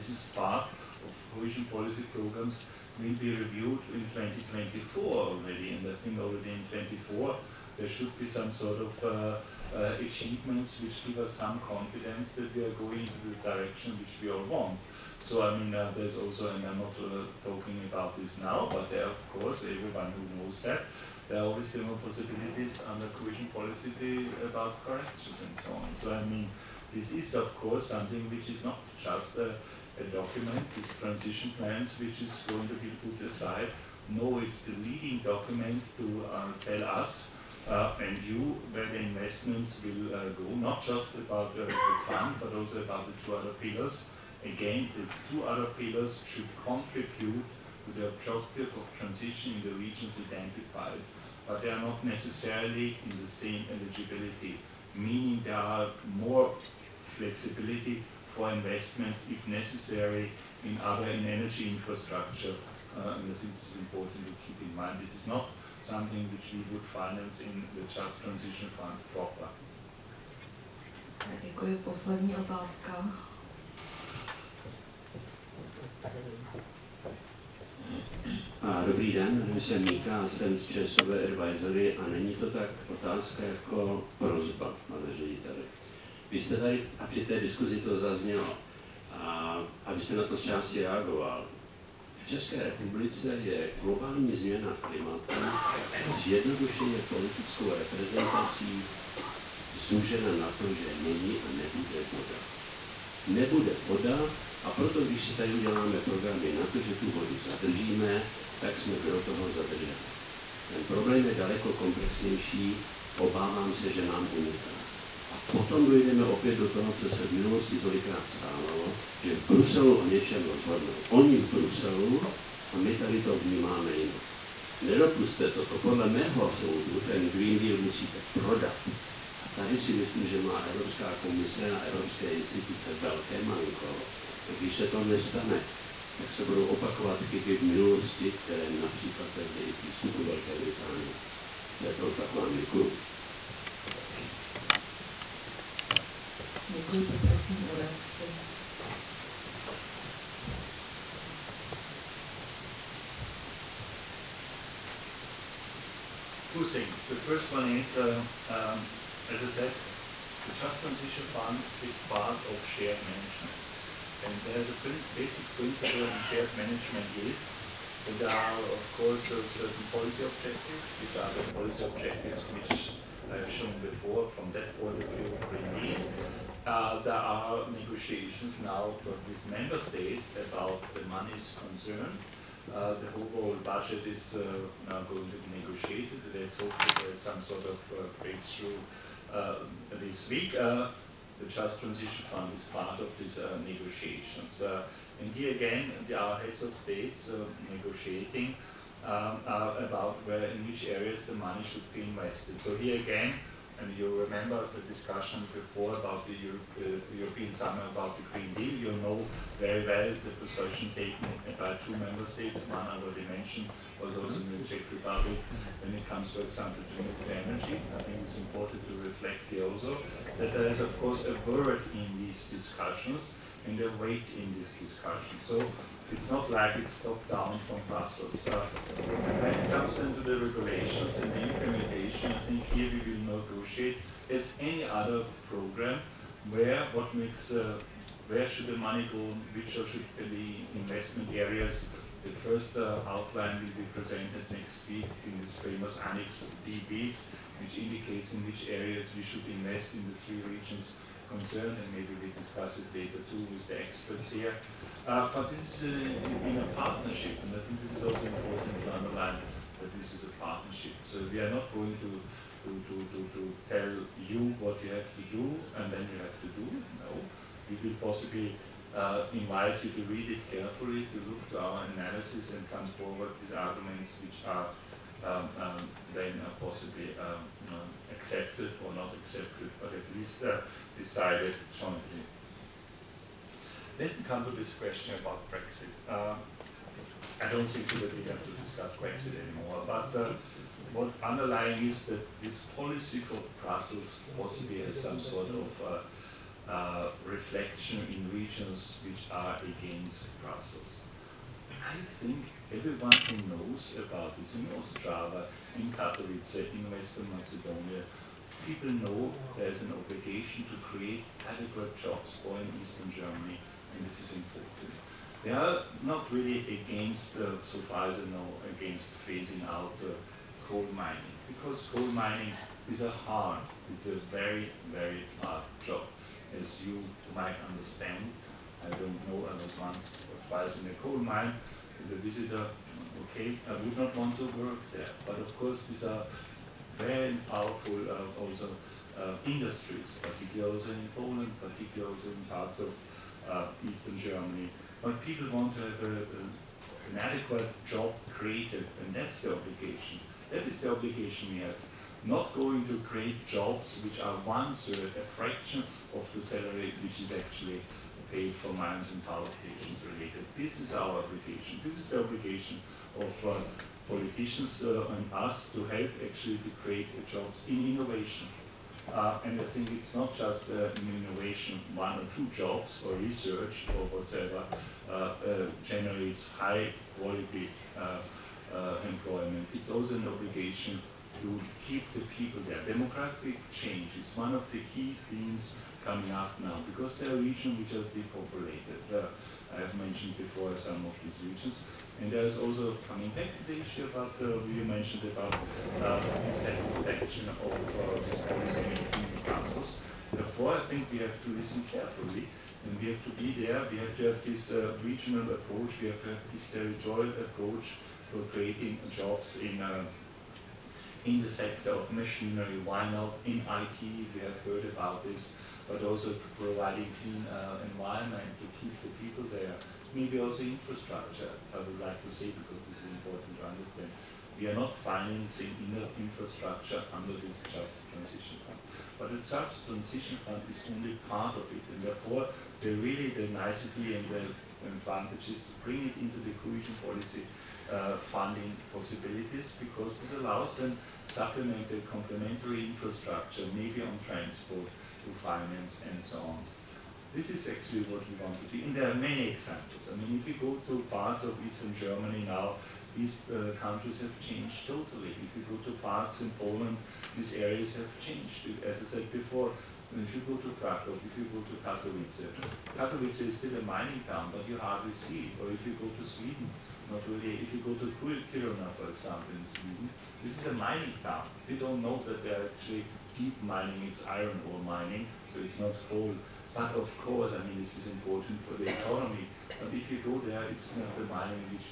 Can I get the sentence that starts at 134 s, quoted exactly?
Když se to nestane, tak se budou opakovat chyby v minulosti, které například vedly i k výstupu Velké Británie.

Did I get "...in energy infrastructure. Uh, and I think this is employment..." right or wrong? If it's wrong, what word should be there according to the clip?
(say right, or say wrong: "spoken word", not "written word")
wrong: "important", not "employment".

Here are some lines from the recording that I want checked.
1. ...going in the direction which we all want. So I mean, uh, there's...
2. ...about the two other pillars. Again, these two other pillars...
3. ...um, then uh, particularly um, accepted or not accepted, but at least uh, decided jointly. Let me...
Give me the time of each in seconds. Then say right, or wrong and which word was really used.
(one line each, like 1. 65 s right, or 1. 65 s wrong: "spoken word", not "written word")
1. 12 s right
2. 42 s right
3. 275 s wrong: "possibly", not "particularly".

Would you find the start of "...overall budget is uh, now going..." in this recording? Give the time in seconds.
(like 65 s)
183 s.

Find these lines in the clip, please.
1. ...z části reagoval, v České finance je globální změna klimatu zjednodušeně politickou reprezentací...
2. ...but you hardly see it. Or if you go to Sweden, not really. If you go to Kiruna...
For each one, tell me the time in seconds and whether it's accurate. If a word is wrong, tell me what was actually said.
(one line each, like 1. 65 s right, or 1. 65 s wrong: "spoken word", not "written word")
1. 90 s wrong: "republice", not "finance"
2. 464 s right.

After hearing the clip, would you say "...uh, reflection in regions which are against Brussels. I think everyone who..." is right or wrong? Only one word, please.
right.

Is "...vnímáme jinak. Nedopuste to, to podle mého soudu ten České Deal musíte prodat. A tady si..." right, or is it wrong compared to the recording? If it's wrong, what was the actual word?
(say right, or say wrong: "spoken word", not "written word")
wrong: "Green", not "České".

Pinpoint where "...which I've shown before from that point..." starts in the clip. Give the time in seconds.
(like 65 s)
172 s.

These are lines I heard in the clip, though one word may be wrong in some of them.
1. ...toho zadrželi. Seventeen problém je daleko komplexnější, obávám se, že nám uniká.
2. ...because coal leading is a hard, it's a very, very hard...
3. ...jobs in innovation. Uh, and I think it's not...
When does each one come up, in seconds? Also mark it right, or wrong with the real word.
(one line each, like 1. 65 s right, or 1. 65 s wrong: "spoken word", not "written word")
1. 109 s wrong: "Ten", not "Seventeen"
2. 321 s wrong: "mining", not "leading"
3. 367 s right.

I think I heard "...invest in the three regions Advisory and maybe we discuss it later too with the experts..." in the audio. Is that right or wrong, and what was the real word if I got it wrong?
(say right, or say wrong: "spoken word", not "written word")
wrong: "Concern", not "Advisory".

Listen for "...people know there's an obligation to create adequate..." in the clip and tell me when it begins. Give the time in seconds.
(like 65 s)
308 s.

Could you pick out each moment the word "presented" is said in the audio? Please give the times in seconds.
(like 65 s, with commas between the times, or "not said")
243 s.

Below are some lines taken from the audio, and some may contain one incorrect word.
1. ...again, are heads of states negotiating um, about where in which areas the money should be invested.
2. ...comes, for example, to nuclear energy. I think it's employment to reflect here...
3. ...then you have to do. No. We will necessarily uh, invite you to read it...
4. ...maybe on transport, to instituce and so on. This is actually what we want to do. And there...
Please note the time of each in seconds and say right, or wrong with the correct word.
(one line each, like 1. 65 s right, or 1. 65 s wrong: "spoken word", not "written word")
1. 195 s right
2. 216 s wrong: "important", not "employment"
3. 265 s wrong: "possibly", not "necessarily"
4. 443 s wrong: "finance", not "instituce".